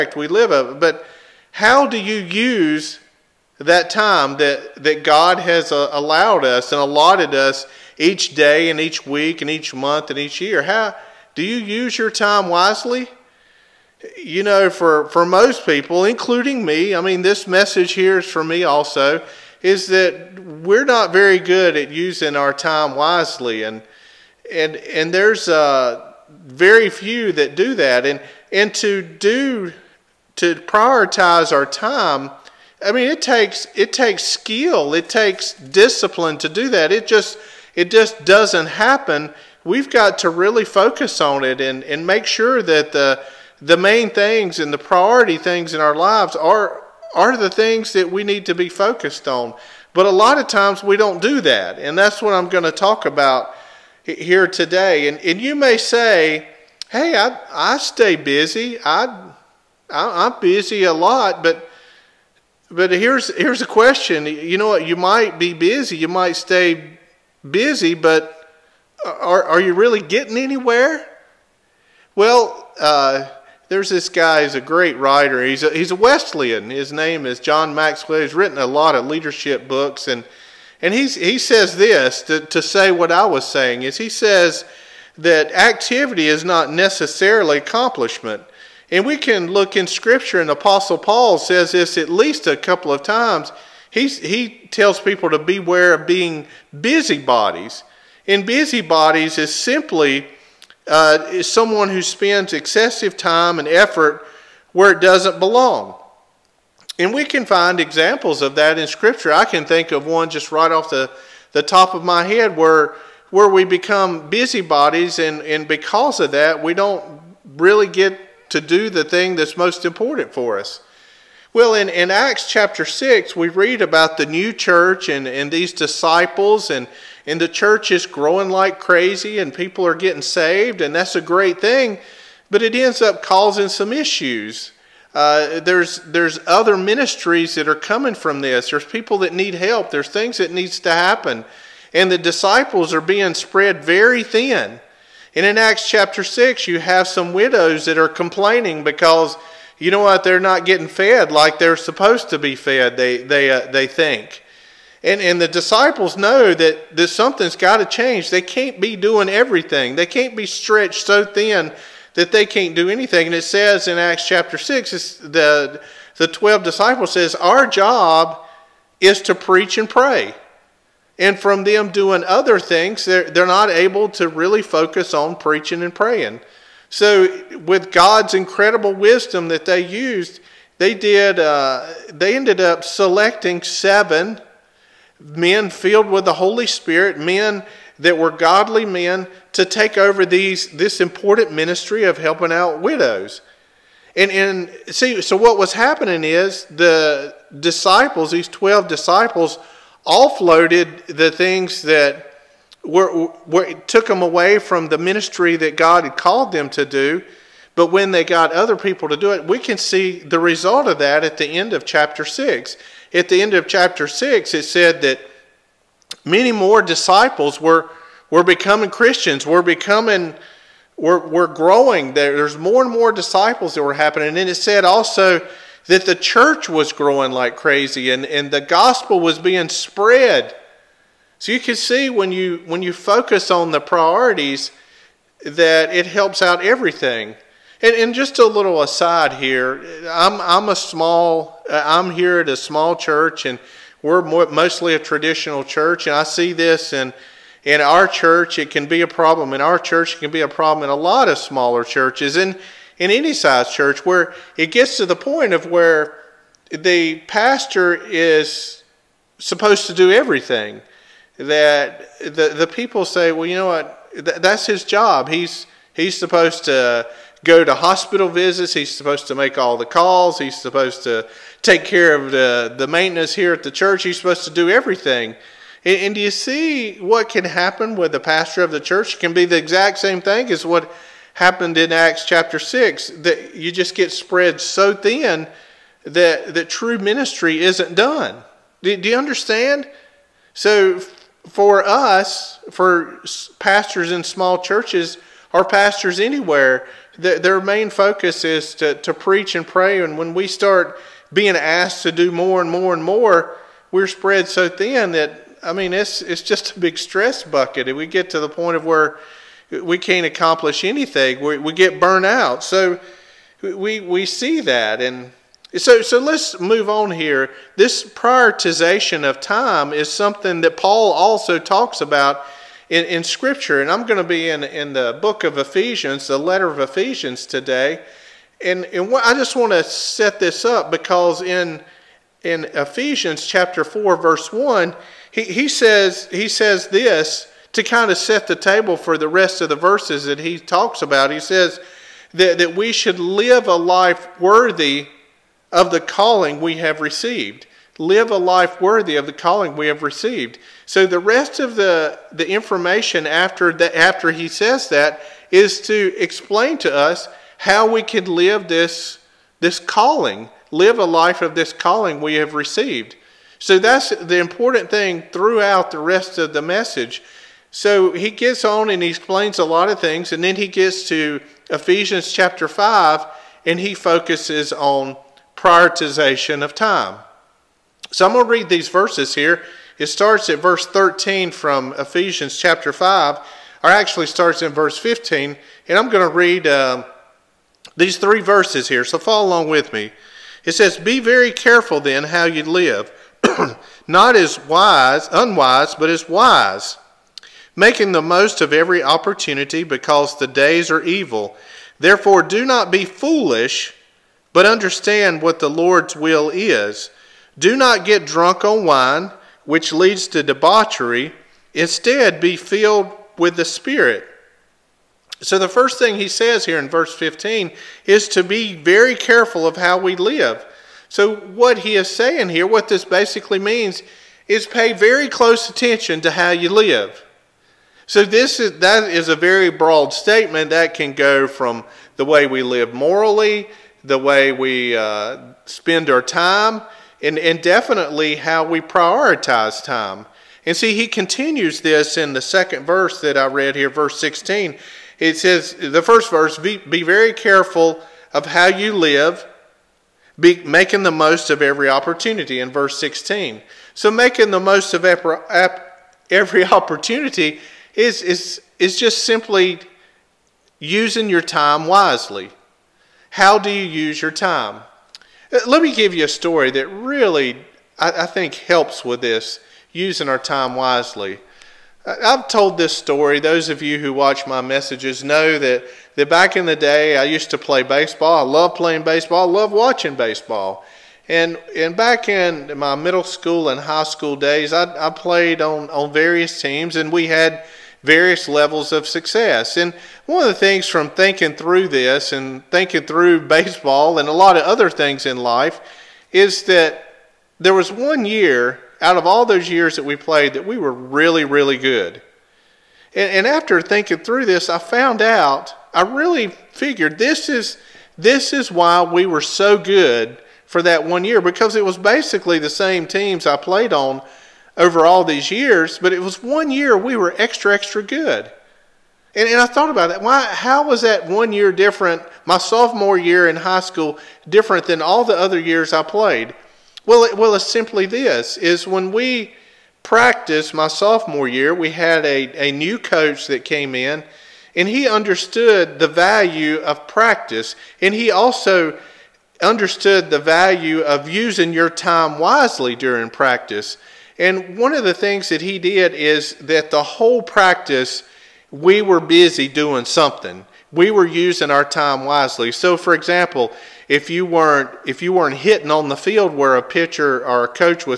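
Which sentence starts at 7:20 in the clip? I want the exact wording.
And see, he continues this in the second verse that I read here, verse 16.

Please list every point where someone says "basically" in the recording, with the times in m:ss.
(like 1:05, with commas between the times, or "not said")
7:03, 8:31.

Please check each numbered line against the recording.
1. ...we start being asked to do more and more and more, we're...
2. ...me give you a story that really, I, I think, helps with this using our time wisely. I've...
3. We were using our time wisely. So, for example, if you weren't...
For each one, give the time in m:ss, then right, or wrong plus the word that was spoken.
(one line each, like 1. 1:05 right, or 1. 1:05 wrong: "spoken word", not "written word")
1. 5:00 right
2. 7:45 right
3. 9:10 right.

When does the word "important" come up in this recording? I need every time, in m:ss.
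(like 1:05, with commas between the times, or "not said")
1:59, 3:10, 6:04.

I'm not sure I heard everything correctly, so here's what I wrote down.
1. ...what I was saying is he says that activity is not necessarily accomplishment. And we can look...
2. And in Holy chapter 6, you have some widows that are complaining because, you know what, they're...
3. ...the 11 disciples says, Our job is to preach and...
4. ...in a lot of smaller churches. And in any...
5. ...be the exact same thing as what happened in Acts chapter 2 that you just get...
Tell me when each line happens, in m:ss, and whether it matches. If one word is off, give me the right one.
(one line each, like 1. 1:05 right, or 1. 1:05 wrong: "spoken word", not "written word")
1. 1:22 right
2. 2:25 wrong: "Acts", not "Holy"
3. 2:46 wrong: "12", not "11"
4. 4:10 right
5. 4:39 wrong: "6", not "2".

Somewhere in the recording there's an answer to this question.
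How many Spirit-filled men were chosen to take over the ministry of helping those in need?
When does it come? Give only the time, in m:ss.
3:03.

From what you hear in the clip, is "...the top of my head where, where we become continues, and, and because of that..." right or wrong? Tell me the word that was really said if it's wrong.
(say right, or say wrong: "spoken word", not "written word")
wrong: "busybodies", not "continues".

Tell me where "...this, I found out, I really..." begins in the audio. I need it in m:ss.
8:24.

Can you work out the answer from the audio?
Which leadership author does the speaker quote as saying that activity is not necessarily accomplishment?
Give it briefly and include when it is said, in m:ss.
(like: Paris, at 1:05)
John Maxwell, at 1:17.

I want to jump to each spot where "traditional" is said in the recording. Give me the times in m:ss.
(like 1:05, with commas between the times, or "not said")
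4:04.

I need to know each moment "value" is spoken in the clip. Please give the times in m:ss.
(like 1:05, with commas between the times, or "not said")
8:56, 9:00.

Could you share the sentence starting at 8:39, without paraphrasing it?
And, and I thought about that.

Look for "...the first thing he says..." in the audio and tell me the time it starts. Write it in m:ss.
6:55.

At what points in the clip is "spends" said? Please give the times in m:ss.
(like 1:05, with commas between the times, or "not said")
1:42, 7:15.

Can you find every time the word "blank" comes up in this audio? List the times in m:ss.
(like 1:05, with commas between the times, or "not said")
not said.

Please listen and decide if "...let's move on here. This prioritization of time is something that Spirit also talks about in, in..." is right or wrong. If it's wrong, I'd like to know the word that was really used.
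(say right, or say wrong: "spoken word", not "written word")
wrong: "Paul", not "Spirit".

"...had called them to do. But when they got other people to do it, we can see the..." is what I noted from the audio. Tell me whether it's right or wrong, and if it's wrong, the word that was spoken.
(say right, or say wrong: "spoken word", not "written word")
right.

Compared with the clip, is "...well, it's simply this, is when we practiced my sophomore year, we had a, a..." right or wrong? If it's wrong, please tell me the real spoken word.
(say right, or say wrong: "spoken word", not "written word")
right.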